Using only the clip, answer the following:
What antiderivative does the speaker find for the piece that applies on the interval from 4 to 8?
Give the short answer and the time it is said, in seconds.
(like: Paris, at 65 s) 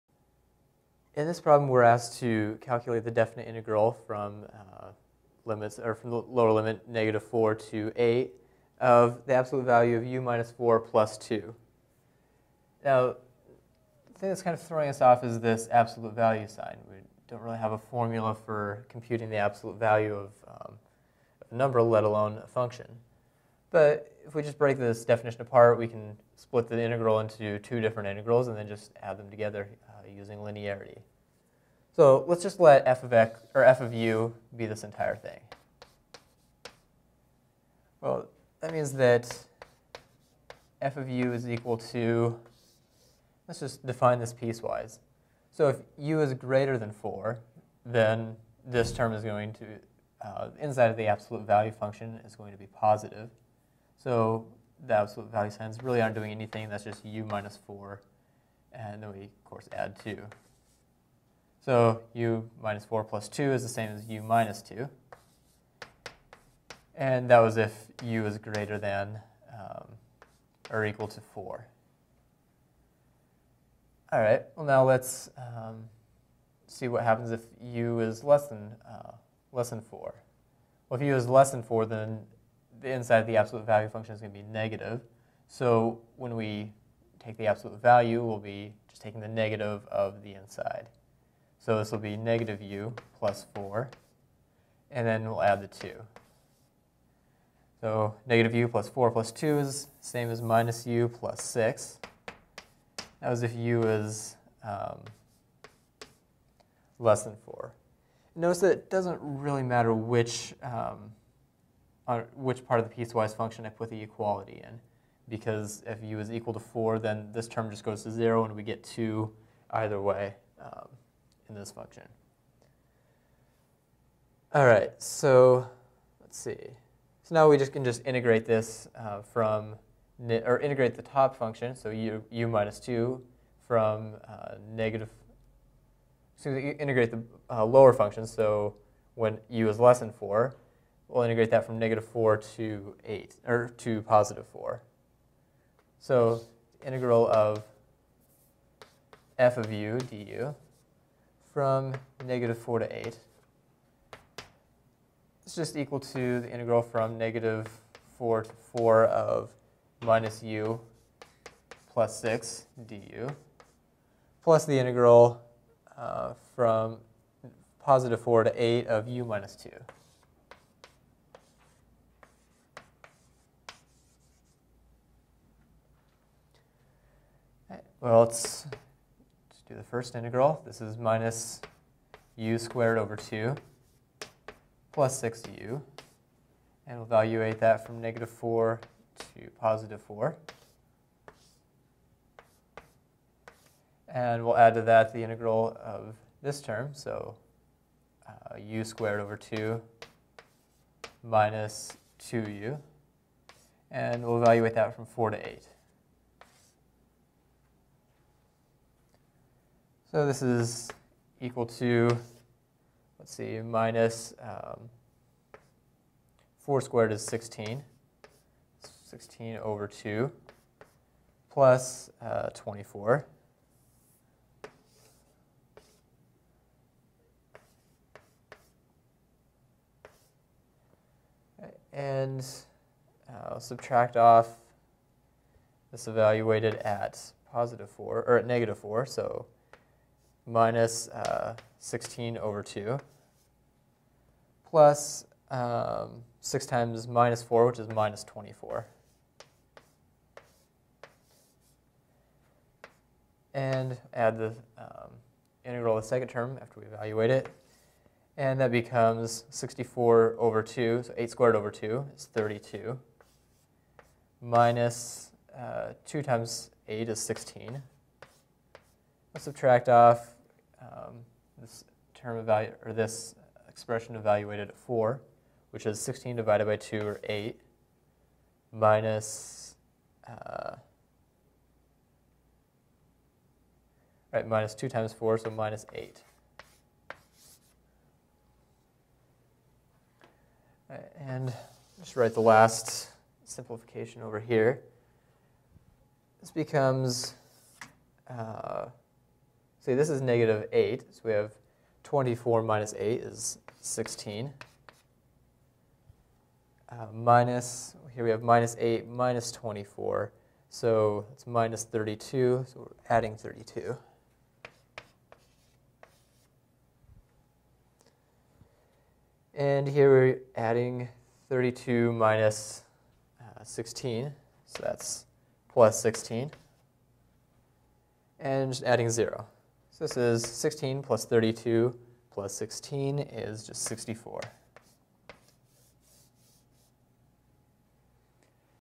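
u^2/2 - 2u, at 198 s.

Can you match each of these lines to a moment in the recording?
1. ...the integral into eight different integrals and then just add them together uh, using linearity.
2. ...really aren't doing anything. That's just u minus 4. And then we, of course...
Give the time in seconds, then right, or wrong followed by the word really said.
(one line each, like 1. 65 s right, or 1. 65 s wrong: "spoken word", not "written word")
1. 26 s wrong: "two", not "eight"
2. 55 s right.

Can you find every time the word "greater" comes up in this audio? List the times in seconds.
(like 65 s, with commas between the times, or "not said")
46 s, 68 s.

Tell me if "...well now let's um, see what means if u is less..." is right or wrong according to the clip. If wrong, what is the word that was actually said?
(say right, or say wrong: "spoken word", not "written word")
wrong: "happens", not "means".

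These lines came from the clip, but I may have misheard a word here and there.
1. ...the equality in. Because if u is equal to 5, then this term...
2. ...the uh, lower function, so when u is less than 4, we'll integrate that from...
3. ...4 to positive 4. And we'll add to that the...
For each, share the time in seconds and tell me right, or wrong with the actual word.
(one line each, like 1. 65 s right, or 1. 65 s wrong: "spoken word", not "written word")
1. 113 s wrong: "4", not "5"
2. 137 s right
3. 188 s right.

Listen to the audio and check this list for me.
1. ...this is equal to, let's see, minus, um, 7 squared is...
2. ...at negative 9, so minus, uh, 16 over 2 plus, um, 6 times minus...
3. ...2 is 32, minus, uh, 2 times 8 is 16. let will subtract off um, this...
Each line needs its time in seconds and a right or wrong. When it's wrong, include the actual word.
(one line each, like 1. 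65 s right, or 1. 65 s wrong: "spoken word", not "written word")
1. 210 s wrong: "4", not "7"
2. 238 s wrong: "4", not "9"
3. 261 s right.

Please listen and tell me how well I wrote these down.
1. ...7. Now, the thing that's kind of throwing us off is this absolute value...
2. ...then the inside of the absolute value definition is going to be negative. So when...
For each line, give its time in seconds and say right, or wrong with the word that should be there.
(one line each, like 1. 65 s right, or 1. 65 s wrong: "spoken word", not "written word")
1. 11 s wrong: "2", not "7"
2. 81 s wrong: "function", not "definition".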